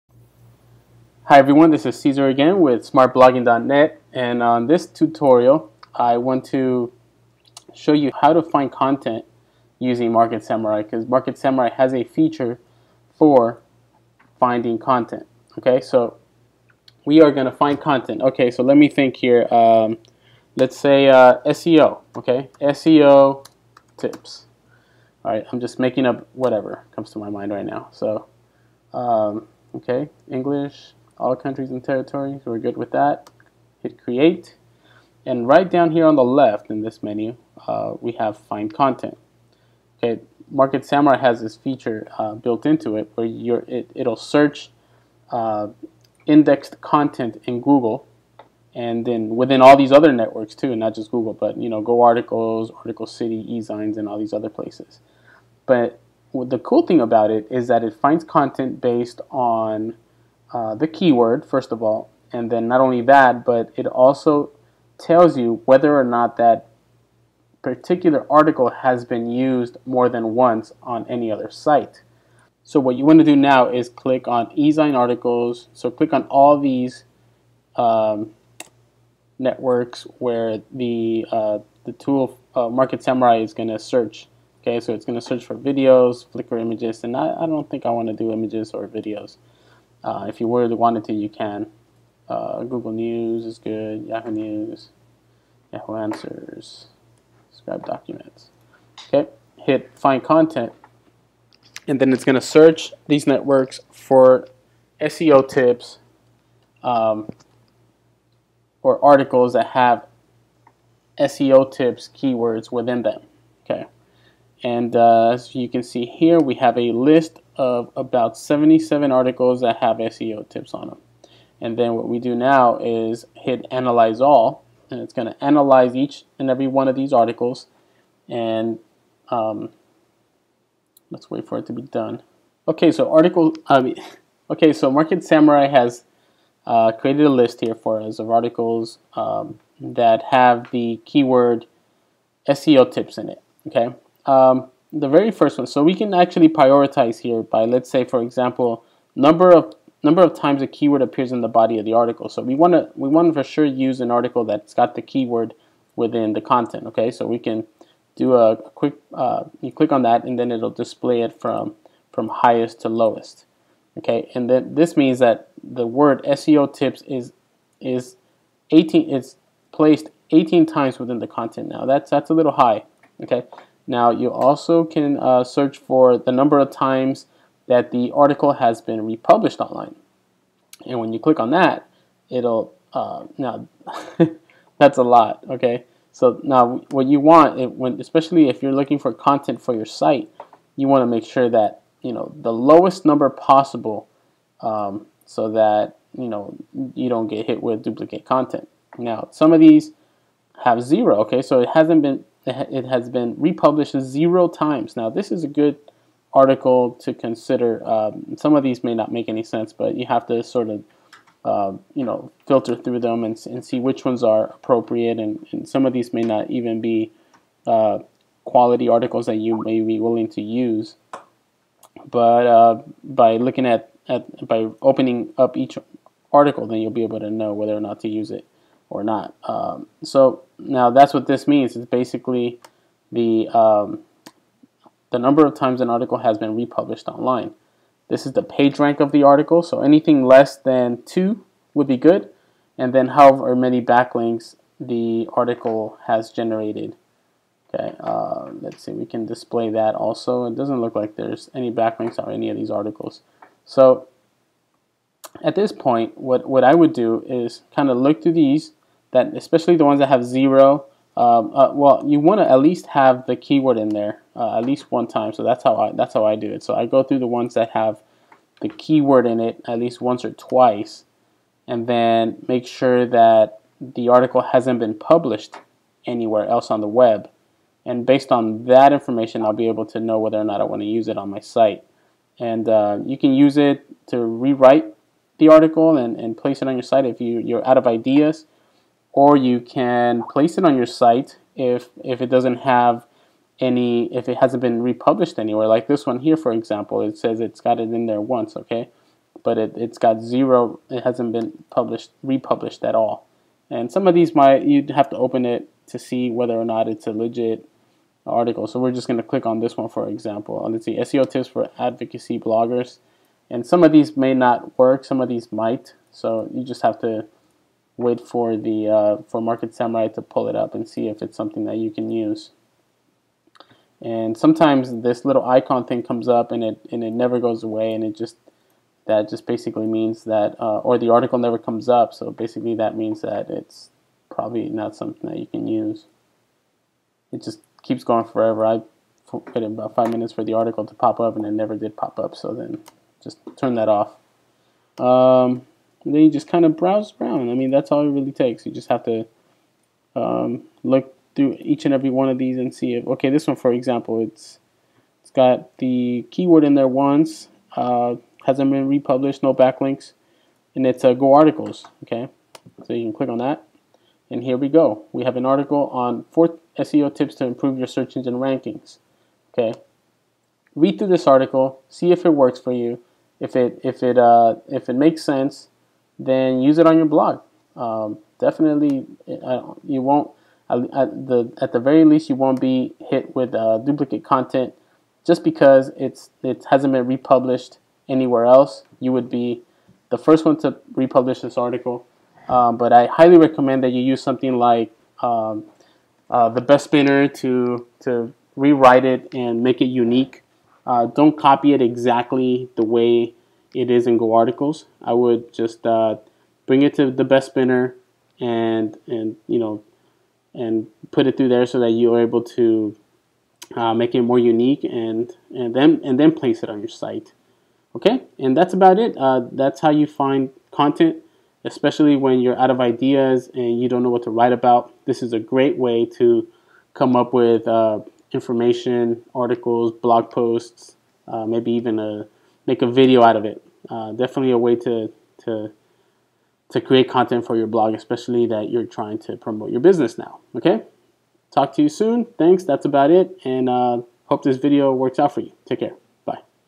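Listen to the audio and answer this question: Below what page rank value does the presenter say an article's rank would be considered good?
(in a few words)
2.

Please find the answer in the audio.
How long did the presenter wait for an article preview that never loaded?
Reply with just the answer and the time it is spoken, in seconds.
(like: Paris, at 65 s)
5 minutes, at 339 s.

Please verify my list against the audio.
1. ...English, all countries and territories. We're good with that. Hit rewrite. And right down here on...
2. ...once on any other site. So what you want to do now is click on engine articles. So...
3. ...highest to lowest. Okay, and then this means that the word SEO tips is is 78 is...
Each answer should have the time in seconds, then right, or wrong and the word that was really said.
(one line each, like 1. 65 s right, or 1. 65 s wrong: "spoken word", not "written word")
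1. 30 s wrong: "create", not "rewrite"
2. 70 s wrong: "eZine", not "engine"
3. 162 s wrong: "18", not "78".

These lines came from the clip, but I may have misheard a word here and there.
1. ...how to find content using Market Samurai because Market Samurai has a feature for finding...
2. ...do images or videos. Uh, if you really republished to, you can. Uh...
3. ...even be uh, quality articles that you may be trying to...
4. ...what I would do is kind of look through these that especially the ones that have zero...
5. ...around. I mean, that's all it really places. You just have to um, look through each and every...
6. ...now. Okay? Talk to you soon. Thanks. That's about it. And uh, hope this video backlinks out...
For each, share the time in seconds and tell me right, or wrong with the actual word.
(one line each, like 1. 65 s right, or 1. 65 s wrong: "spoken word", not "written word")
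1. 8 s right
2. 88 s wrong: "wanted", not "republished"
3. 216 s wrong: "willing", not "trying"
4. 256 s right
5. 347 s wrong: "takes", not "places"
6. 440 s wrong: "works", not "backlinks".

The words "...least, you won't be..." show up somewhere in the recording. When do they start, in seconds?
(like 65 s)
382 s.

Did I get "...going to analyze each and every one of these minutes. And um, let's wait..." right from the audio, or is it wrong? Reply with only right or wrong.
wrong.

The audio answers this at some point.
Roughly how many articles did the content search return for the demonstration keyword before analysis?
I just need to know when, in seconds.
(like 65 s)
118 s.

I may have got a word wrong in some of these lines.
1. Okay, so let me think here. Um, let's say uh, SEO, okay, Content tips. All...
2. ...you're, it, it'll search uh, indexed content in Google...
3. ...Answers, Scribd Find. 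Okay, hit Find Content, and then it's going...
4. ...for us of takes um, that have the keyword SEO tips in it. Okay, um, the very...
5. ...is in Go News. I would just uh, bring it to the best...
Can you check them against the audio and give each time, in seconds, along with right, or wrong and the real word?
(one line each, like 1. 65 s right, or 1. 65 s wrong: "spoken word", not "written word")
1. 18 s wrong: "SEO", not "Content"
2. 43 s right
3. 95 s wrong: "Documents", not "Find"
4. 137 s wrong: "articles", not "takes"
5. 403 s wrong: "Articles", not "News".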